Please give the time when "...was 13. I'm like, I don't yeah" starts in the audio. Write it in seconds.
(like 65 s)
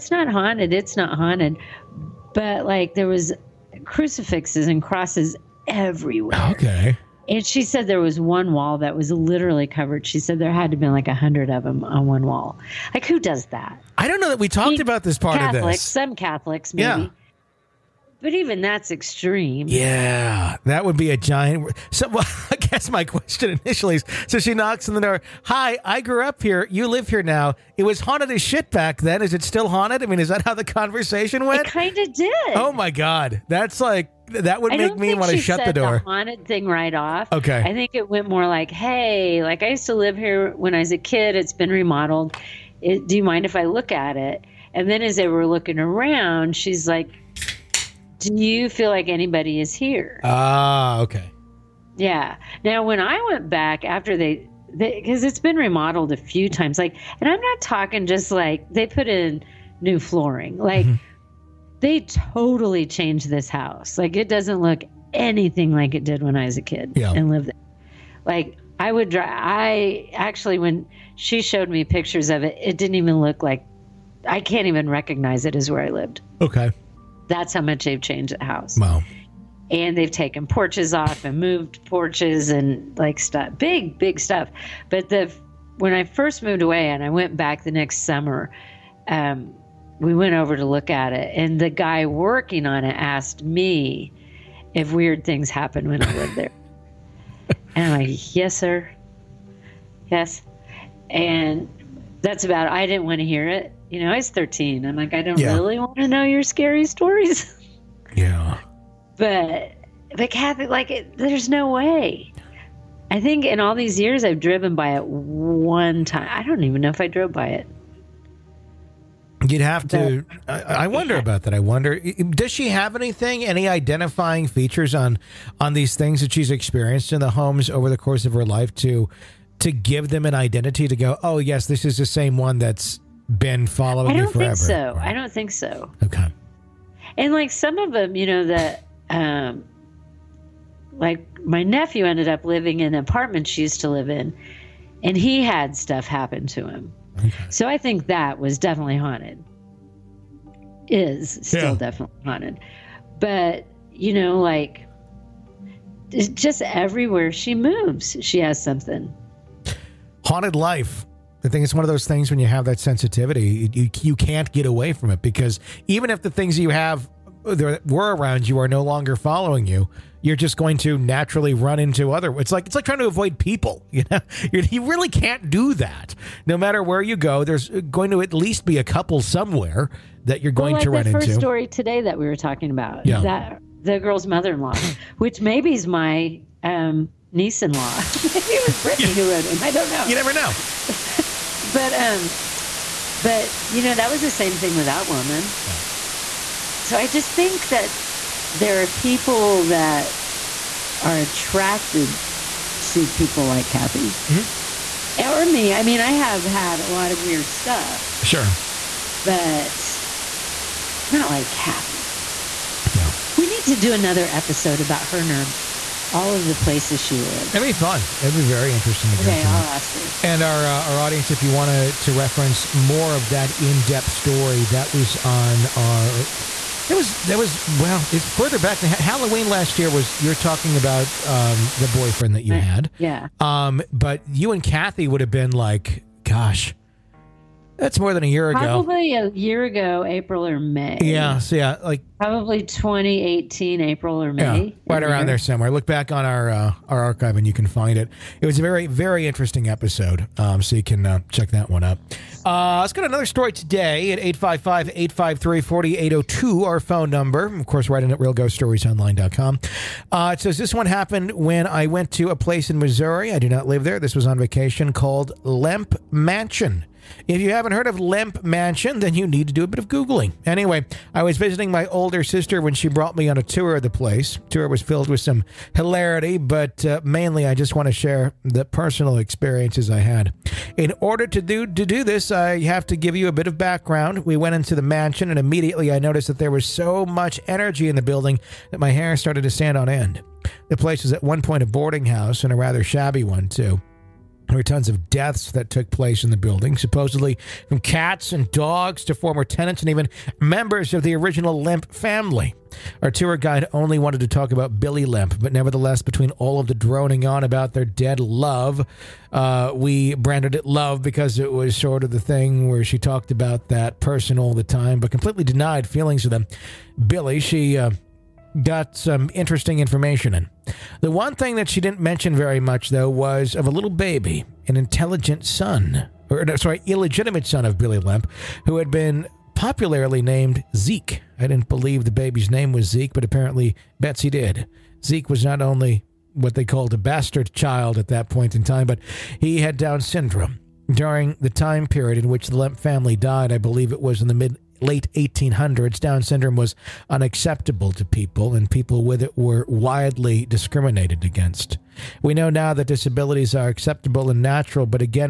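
104 s.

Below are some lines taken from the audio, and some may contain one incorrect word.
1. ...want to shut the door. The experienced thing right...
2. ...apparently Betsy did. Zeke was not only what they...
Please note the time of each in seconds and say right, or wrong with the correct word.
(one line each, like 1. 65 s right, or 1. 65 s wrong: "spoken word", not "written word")
1. 35 s wrong: "haunted", not "experienced"
2. 333 s right.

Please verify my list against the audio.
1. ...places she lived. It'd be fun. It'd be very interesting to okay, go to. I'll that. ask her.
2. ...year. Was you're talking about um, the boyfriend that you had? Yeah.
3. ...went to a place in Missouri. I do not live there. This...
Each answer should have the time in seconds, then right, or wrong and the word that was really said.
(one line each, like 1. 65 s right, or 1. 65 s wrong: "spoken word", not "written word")
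1. 216 s right
2. 229 s right
3. 261 s right.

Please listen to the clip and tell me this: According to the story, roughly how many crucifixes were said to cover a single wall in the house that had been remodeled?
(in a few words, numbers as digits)
100.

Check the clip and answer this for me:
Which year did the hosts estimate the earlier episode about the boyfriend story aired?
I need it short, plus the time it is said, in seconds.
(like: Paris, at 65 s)
2018, at 242 s.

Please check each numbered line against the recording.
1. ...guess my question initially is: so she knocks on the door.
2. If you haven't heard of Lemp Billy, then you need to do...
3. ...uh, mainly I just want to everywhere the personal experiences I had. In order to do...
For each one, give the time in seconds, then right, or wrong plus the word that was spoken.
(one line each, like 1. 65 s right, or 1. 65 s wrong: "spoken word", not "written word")
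1. 22 s right
2. 267 s wrong: "Mansion", not "Billy"
3. 276 s wrong: "share", not "everywhere".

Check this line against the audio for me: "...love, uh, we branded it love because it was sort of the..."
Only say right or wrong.
right.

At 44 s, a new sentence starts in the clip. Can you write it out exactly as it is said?
And then as they were looking around, she's like do you feel like anybody is here?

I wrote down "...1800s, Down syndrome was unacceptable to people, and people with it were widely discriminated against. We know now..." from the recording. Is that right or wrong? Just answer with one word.
right.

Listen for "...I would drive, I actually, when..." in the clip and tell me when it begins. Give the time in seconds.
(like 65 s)
68 s.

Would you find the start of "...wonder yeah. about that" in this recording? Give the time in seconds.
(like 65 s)
120 s.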